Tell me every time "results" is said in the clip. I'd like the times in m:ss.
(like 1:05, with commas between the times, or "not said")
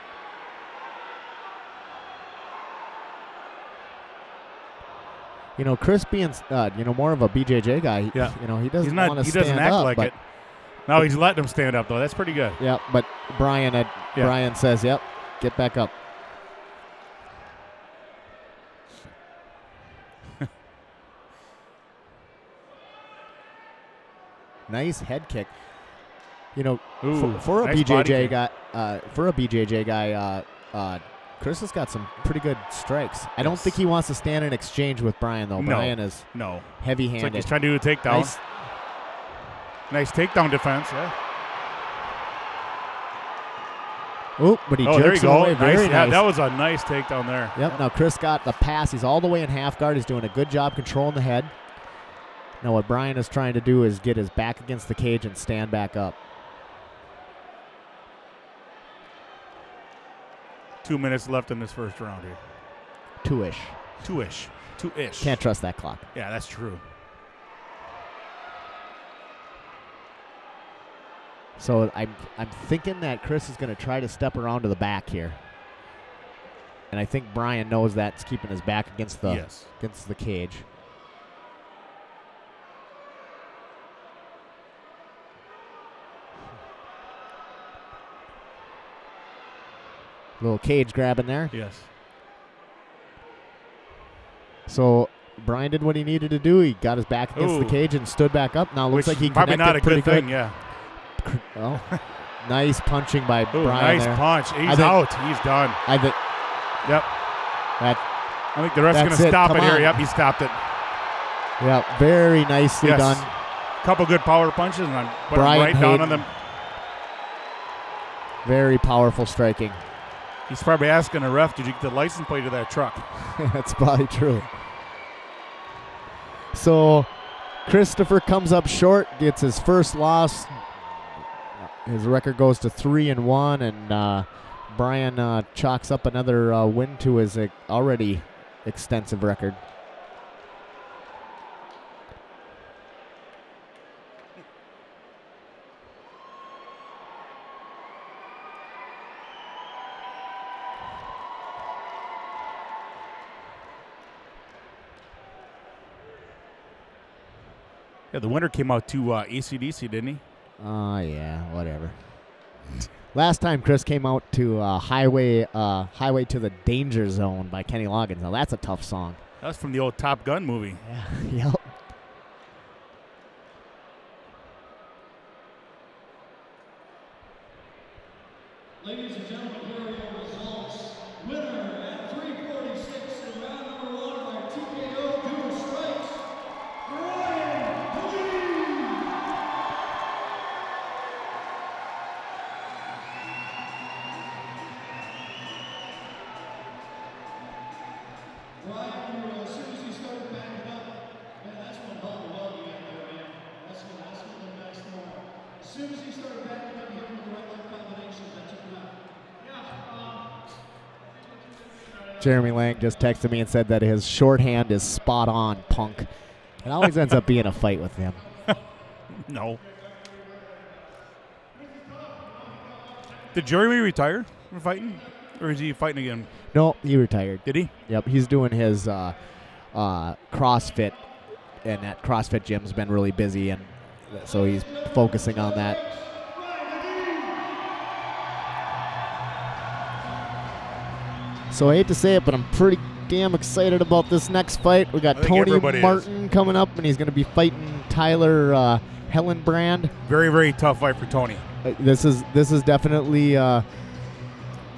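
3:00.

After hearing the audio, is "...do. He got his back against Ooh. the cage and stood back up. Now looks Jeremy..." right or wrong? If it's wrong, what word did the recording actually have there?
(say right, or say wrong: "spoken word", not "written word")
wrong: "Which", not "Jeremy".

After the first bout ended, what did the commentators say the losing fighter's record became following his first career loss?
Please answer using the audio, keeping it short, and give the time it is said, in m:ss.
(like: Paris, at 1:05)
3-1, at 2:12.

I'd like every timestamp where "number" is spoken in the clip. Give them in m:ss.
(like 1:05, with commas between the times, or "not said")
3:03.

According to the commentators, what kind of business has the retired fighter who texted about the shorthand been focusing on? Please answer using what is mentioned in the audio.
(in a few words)
CrossFit gym.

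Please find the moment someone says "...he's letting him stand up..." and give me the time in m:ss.
0:11.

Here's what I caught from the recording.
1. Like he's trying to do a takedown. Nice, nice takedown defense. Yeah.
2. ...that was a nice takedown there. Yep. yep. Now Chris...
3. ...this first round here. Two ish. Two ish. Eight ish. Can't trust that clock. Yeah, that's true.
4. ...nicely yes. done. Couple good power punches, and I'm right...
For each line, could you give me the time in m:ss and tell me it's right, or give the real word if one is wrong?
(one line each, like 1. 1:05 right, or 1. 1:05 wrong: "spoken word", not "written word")
1. 0:37 right
2. 0:46 right
3. 1:01 wrong: "Two", not "Eight"
4. 1:52 right.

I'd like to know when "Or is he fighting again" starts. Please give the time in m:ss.
3:45.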